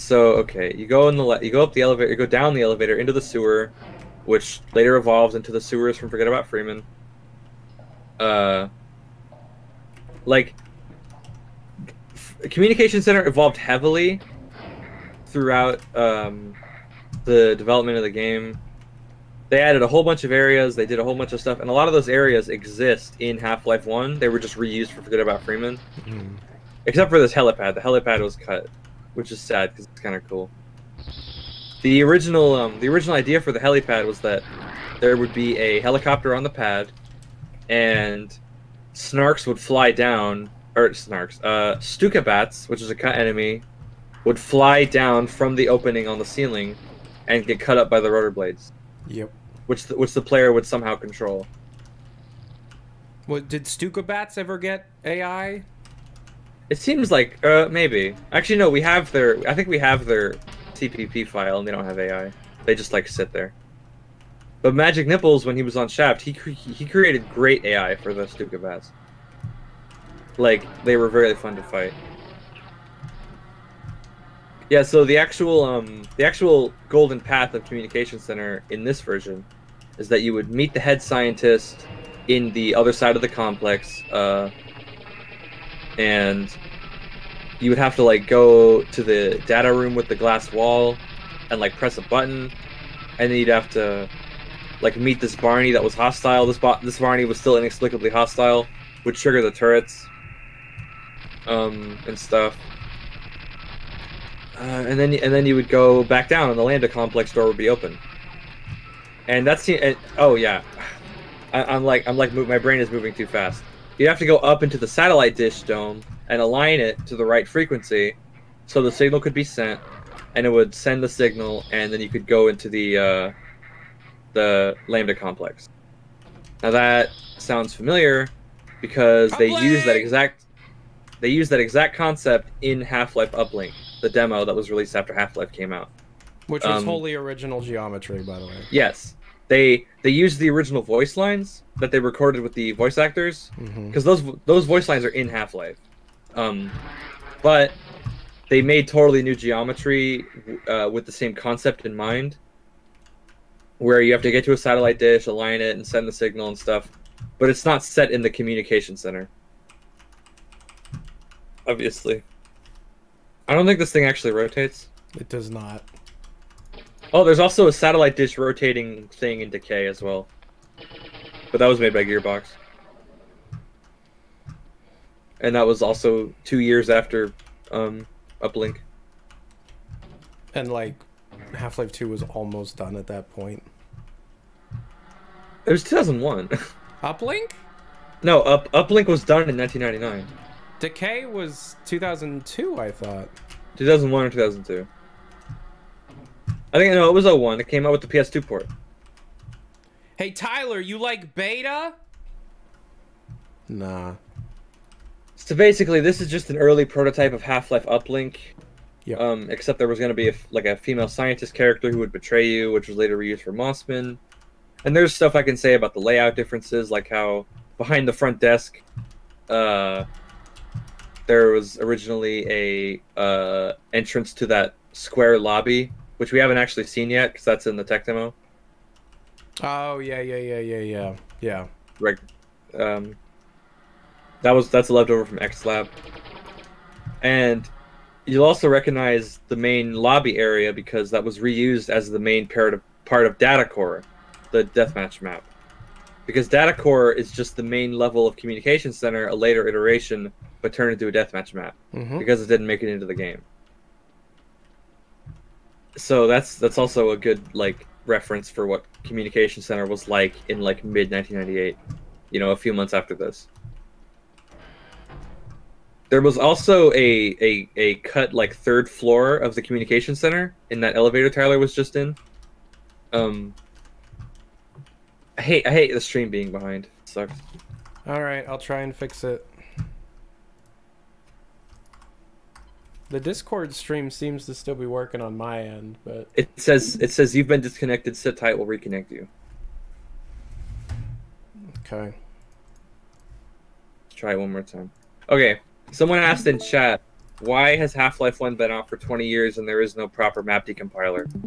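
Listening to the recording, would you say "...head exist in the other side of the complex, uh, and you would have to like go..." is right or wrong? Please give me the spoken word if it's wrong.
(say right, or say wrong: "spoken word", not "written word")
wrong: "scientist", not "exist".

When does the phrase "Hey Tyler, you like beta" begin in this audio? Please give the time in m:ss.
3:20.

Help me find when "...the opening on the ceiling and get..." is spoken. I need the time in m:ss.
0:45.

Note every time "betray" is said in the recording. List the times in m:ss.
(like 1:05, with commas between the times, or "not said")
3:32.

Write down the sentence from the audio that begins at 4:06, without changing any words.
Because Data Core is just the main level of communication center, a later iteration but turned into a deathmatch map mm-hmm.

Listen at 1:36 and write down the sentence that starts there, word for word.
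This bo- this Barney was still inexplicably hostile, would trigger the turrets um, and stuff.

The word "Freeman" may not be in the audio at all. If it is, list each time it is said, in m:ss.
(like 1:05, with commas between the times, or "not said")
0:06, 0:25.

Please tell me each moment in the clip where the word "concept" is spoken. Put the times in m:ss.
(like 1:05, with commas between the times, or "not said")
2:11, 2:31.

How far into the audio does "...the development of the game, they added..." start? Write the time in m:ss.
0:17.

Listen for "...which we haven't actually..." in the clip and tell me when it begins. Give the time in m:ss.
3:46.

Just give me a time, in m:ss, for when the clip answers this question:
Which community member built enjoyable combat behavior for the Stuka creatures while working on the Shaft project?
1:04.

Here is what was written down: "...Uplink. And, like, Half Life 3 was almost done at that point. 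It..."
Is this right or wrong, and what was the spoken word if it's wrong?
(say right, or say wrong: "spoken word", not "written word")
wrong: "2", not "3".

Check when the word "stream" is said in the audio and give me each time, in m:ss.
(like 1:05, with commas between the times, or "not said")
4:35, 4:43.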